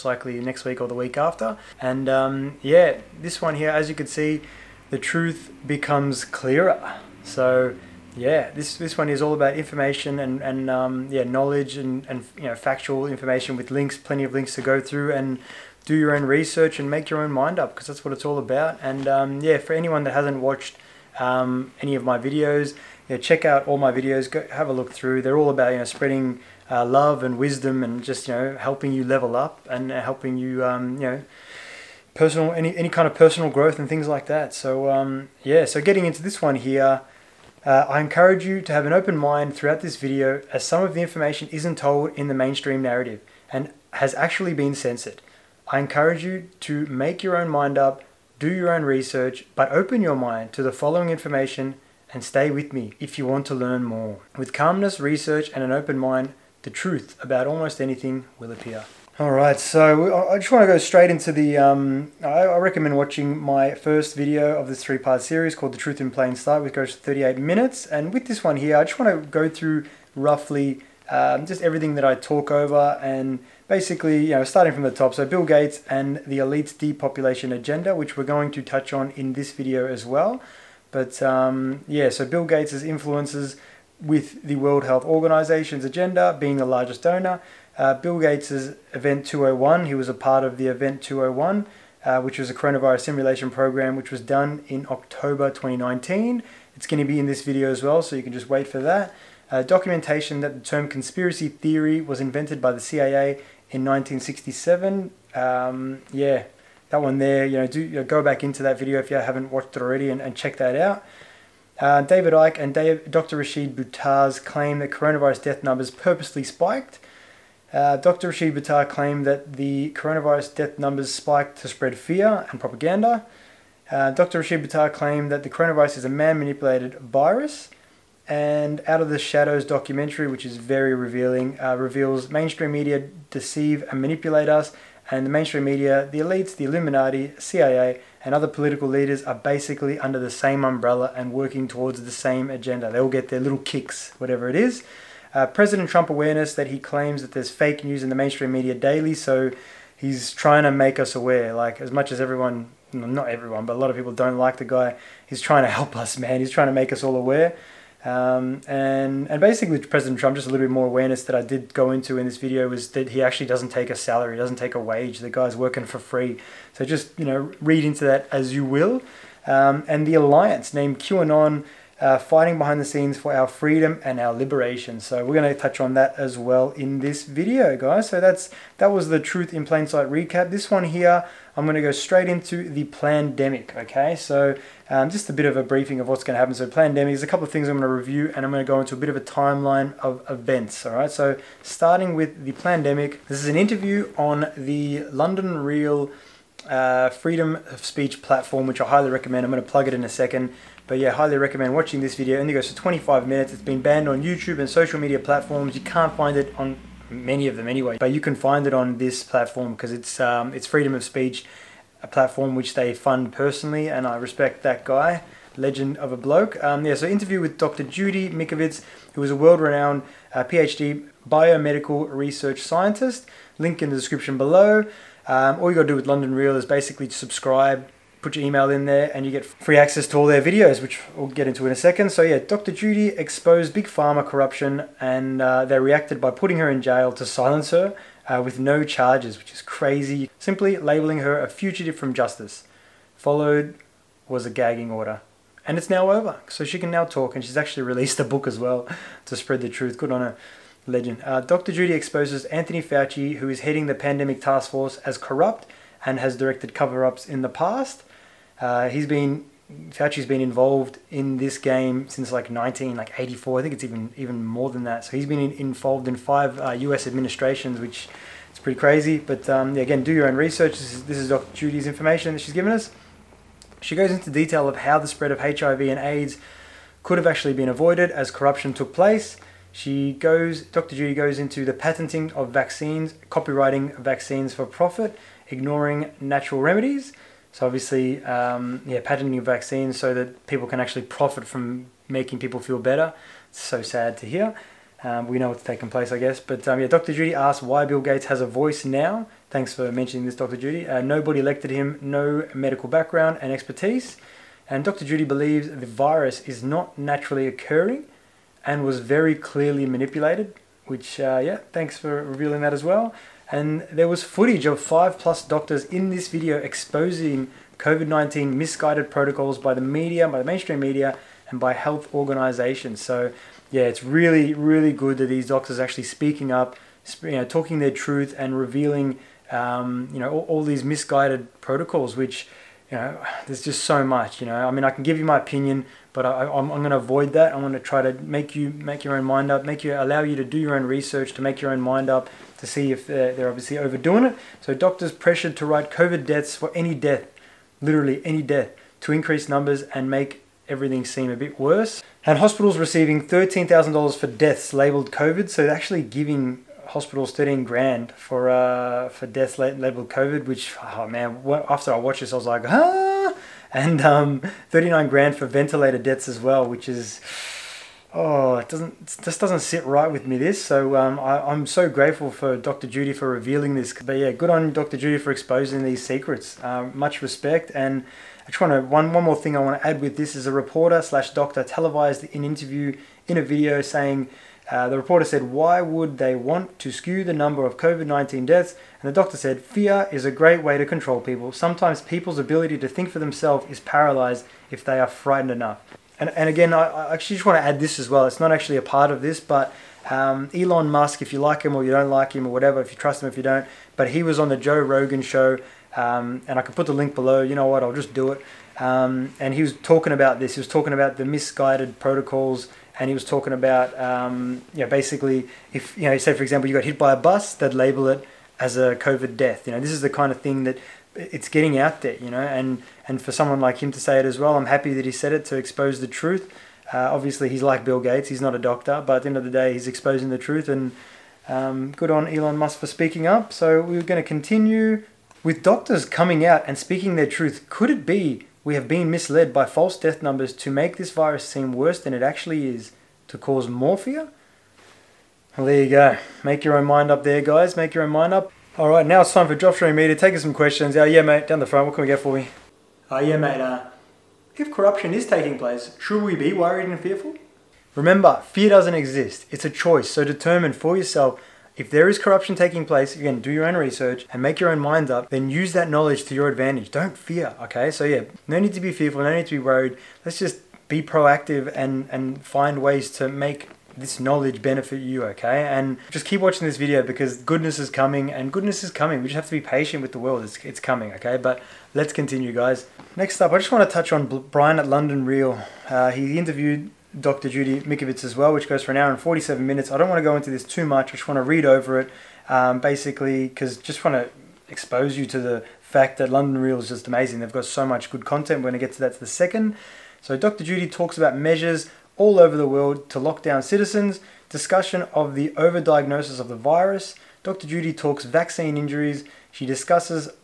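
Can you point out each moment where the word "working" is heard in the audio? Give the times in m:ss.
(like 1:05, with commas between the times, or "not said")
2:21, 2:45.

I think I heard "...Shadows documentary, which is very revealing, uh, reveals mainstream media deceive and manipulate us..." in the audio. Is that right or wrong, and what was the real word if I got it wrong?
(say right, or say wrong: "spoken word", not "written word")
right.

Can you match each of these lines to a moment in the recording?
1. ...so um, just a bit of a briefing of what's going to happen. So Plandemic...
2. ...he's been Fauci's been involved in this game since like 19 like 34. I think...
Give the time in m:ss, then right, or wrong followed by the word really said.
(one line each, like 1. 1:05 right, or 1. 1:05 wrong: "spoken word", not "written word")
1. 3:04 right
2. 4:18 wrong: "84", not "34".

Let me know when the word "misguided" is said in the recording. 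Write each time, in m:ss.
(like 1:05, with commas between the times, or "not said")
5:18, 5:30, 6:51.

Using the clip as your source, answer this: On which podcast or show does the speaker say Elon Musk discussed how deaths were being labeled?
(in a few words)
Joe Rogan show.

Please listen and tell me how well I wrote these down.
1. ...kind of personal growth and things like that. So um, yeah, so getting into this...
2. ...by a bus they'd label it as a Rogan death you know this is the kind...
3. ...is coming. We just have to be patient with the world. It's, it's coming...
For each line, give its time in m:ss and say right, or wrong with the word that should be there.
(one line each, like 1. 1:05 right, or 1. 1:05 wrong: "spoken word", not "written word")
1. 0:32 right
2. 6:56 wrong: "COVID", not "Rogan"
3. 7:58 right.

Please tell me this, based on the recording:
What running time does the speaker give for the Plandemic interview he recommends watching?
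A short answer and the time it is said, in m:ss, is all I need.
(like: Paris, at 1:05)
25 minutes, at 3:22.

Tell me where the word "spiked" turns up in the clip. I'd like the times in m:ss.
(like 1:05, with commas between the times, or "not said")
1:56, 2:01.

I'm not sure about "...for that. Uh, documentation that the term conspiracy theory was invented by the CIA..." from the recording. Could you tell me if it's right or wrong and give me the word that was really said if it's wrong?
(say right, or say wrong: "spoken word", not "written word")
right.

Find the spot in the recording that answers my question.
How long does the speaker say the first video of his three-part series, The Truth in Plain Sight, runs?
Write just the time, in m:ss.
1:06.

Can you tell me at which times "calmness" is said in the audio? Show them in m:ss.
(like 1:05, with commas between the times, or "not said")
0:54.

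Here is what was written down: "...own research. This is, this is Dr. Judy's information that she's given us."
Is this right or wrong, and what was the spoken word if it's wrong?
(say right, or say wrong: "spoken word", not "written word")
right.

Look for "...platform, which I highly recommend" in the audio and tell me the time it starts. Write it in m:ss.
3:18.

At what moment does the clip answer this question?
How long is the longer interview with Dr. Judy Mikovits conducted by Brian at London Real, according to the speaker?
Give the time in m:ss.
8:08.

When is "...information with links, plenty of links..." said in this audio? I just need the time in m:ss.
0:13.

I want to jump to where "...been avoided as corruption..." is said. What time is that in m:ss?
4:37.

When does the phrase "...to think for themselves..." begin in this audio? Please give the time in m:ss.
6:32.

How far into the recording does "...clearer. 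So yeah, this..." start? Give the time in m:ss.
0:06.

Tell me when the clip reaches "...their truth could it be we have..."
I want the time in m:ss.
7:17.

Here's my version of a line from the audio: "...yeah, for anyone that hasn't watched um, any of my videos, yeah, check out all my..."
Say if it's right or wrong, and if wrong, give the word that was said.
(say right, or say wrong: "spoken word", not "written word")
right.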